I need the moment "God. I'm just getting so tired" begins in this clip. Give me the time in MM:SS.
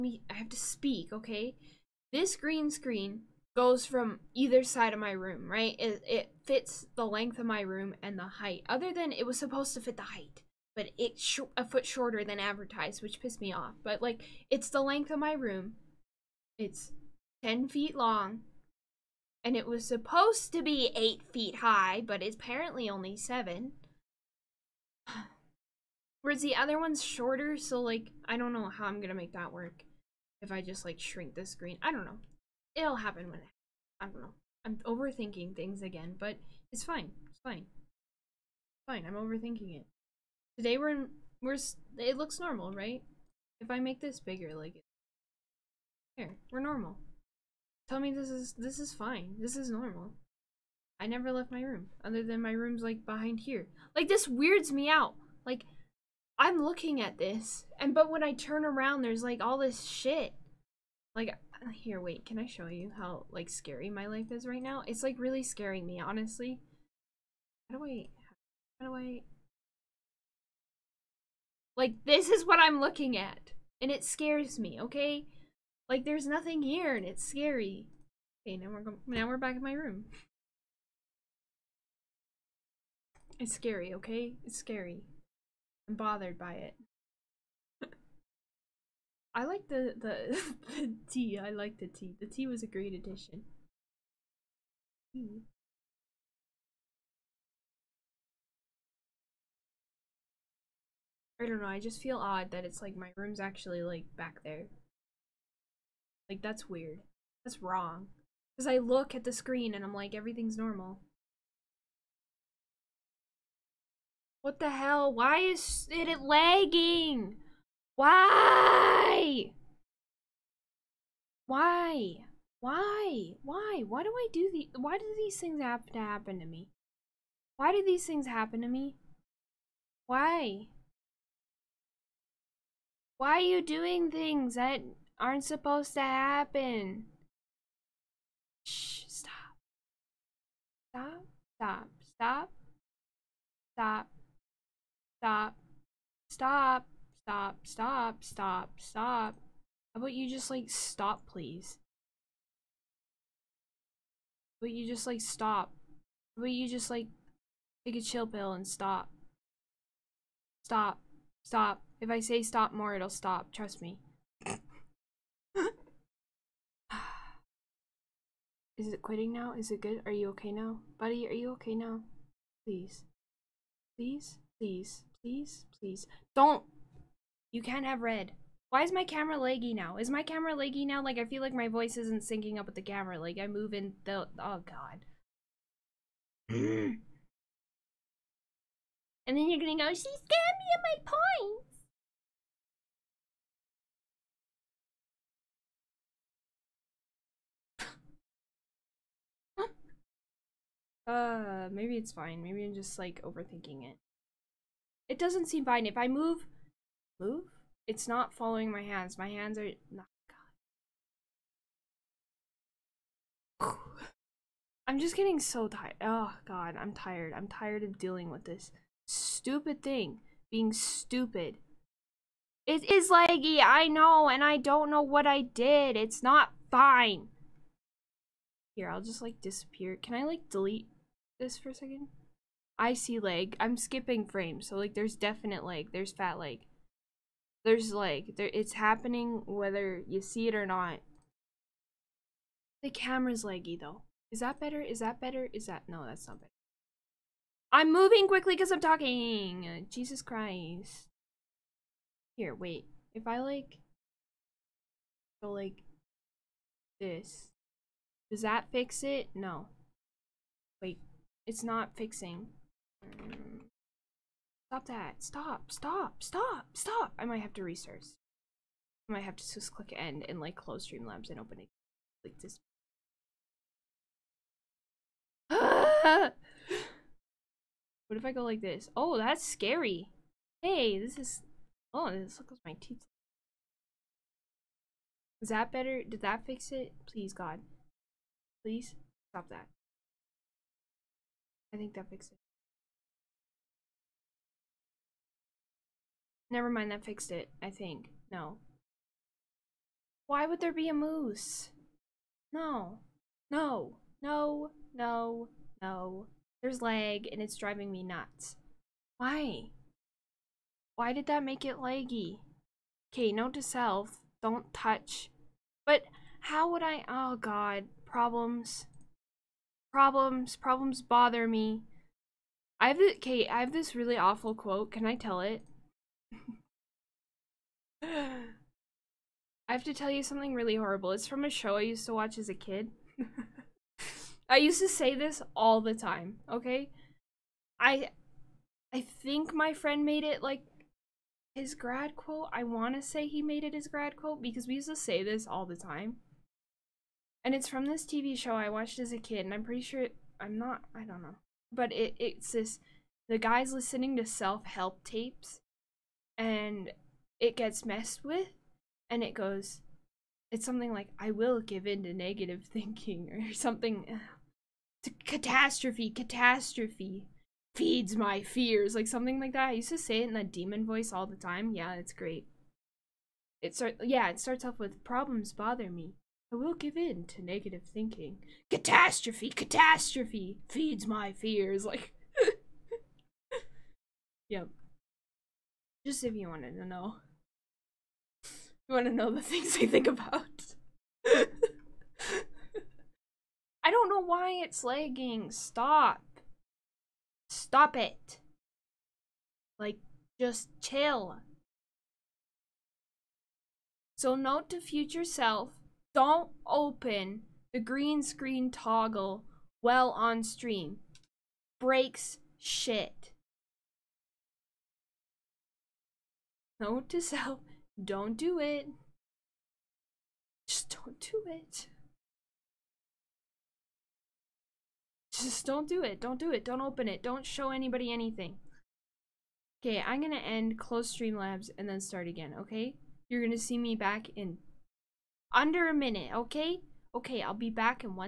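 03:33.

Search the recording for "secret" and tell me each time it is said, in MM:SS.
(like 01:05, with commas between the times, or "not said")
not said.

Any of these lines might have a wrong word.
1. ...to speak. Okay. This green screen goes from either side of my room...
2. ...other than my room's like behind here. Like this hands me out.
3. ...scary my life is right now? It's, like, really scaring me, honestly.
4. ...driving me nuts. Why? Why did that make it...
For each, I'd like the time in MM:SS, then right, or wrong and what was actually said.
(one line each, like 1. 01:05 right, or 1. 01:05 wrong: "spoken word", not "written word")
1. 00:00 right
2. 00:52 wrong: "weirds", not "hands"
3. 01:03 right
4. 05:07 right.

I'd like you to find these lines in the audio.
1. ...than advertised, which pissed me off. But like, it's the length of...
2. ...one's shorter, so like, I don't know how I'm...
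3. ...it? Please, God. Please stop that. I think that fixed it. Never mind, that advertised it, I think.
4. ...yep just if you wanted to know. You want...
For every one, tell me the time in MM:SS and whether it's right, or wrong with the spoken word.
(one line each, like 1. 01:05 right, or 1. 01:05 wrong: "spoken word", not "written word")
1. 00:12 right
2. 00:26 right
3. 04:46 wrong: "fixed", not "advertised"
4. 06:24 right.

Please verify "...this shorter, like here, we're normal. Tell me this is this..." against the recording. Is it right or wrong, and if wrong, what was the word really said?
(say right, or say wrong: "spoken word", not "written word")
wrong: "bigger", not "shorter".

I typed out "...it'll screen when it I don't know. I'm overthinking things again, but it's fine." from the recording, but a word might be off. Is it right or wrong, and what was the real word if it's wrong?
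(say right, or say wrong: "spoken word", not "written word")
wrong: "happen", not "screen".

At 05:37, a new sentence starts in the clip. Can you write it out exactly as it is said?
I I think my friend made it like his grad quote.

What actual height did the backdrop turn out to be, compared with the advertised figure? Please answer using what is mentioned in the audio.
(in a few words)
7 feet.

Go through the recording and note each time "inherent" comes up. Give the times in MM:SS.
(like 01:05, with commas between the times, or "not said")
not said.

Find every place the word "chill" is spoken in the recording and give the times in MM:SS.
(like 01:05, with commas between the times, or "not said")
02:38, 06:40.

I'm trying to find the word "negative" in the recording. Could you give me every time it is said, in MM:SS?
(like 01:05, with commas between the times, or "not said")
06:02, 06:17.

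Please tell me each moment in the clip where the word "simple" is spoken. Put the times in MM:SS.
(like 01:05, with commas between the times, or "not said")
not said.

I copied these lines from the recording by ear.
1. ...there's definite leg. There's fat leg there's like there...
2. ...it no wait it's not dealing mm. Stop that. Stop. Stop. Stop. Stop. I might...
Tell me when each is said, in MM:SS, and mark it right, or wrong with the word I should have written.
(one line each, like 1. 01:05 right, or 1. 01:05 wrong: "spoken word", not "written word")
1. 03:54 right
2. 04:19 wrong: "fixing", not "dealing".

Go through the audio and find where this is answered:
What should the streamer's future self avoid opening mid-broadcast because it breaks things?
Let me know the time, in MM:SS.
06:47.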